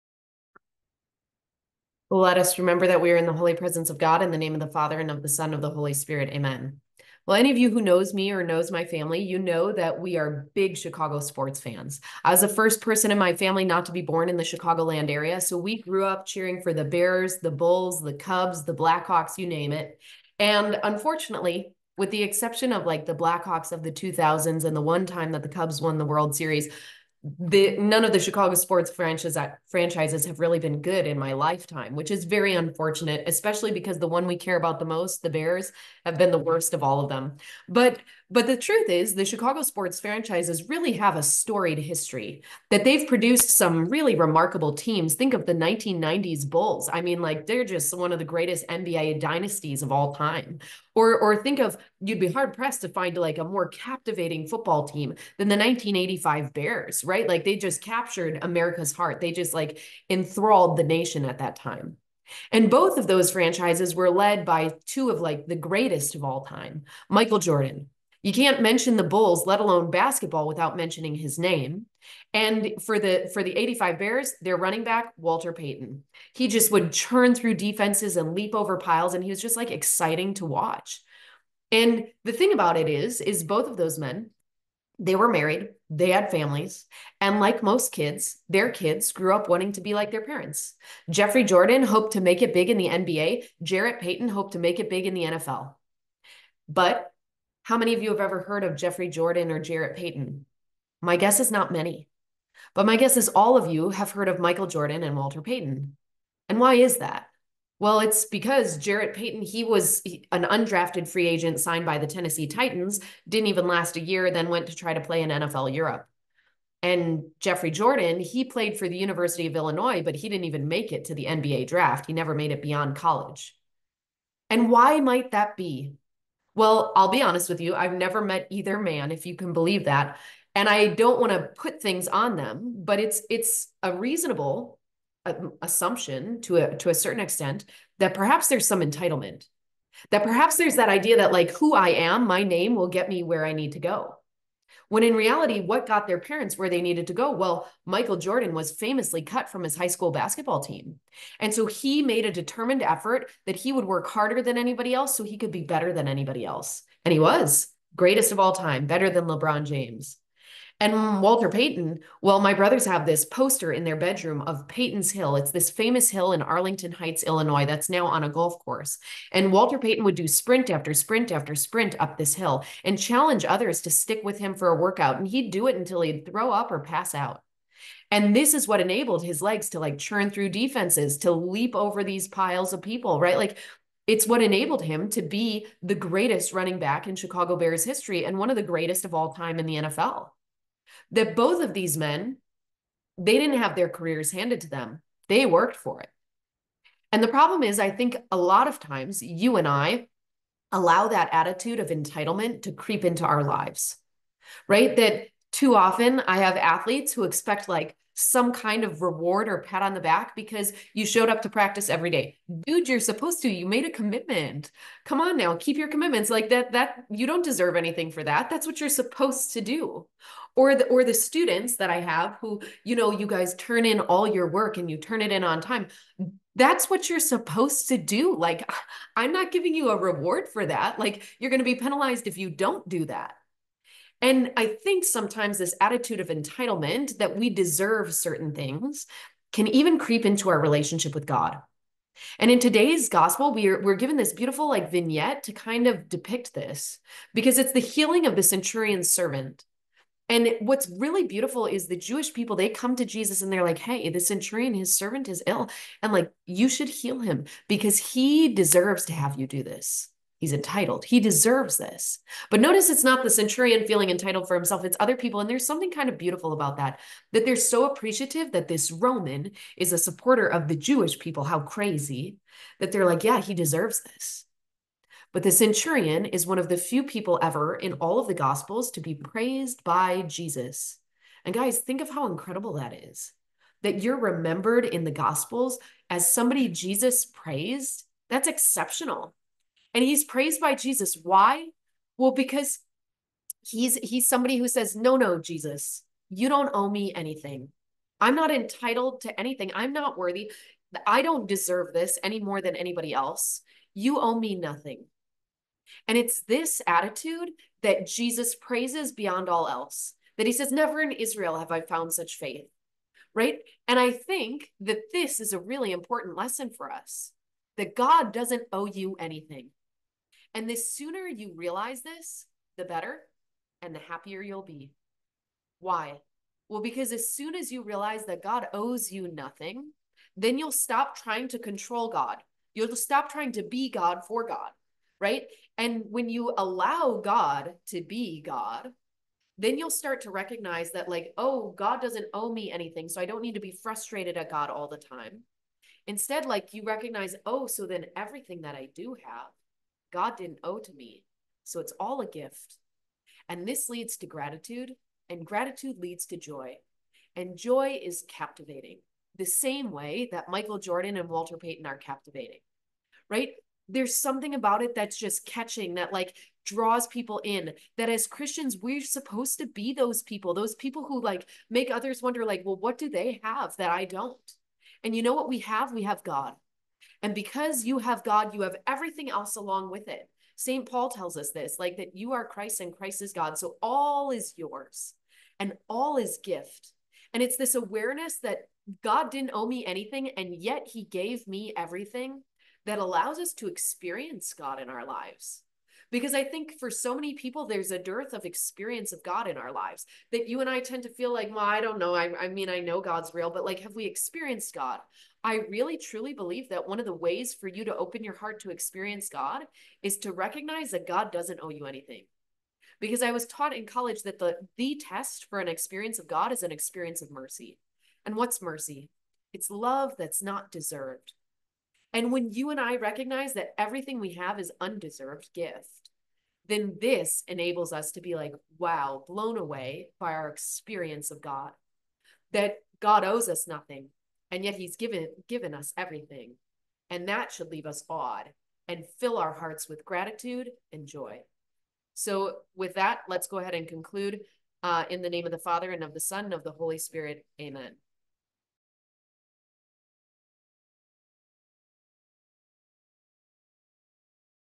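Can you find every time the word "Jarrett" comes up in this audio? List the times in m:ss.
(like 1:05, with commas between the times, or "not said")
1:33, 1:39, 1:48.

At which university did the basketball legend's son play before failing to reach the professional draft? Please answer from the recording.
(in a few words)
University of Illinois.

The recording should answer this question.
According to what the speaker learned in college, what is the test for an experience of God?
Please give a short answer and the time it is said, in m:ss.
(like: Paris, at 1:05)
An experience of mercy, at 6:56.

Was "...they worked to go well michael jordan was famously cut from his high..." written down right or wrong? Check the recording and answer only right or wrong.
wrong.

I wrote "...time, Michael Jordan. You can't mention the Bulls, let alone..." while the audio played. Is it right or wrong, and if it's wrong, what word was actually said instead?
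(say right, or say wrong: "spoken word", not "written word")
right.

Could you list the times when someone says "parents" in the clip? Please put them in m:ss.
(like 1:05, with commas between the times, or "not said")
1:30, 2:26.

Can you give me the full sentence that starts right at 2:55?
And he'd do it until he'd throw up or pass out.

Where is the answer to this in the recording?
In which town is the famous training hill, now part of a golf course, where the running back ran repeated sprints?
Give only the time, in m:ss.
2:46.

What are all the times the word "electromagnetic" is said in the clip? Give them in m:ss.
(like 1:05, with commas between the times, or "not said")
not said.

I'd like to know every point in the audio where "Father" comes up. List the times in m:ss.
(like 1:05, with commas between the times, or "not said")
0:04, 7:25.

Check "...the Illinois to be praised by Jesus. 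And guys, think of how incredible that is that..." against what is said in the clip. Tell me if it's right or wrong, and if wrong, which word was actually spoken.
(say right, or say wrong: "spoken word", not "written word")
wrong: "Gospels", not "Illinois".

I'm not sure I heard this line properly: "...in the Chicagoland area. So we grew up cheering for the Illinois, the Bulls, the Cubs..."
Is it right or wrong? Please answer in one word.
wrong.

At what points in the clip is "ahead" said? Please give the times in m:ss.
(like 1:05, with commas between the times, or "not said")
7:23.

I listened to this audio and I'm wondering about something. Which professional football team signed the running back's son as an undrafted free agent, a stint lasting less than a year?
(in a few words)
Tennessee Titans.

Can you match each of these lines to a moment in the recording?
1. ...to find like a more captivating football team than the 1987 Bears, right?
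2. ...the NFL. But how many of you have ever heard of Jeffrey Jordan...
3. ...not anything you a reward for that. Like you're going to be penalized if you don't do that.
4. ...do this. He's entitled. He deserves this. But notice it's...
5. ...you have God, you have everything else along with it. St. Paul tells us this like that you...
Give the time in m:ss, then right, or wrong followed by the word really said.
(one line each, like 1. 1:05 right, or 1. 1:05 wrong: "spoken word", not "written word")
1. 0:52 wrong: "1985", not "1987"
2. 1:35 right
3. 3:49 wrong: "giving", not "anything"
4. 4:19 right
5. 6:17 right.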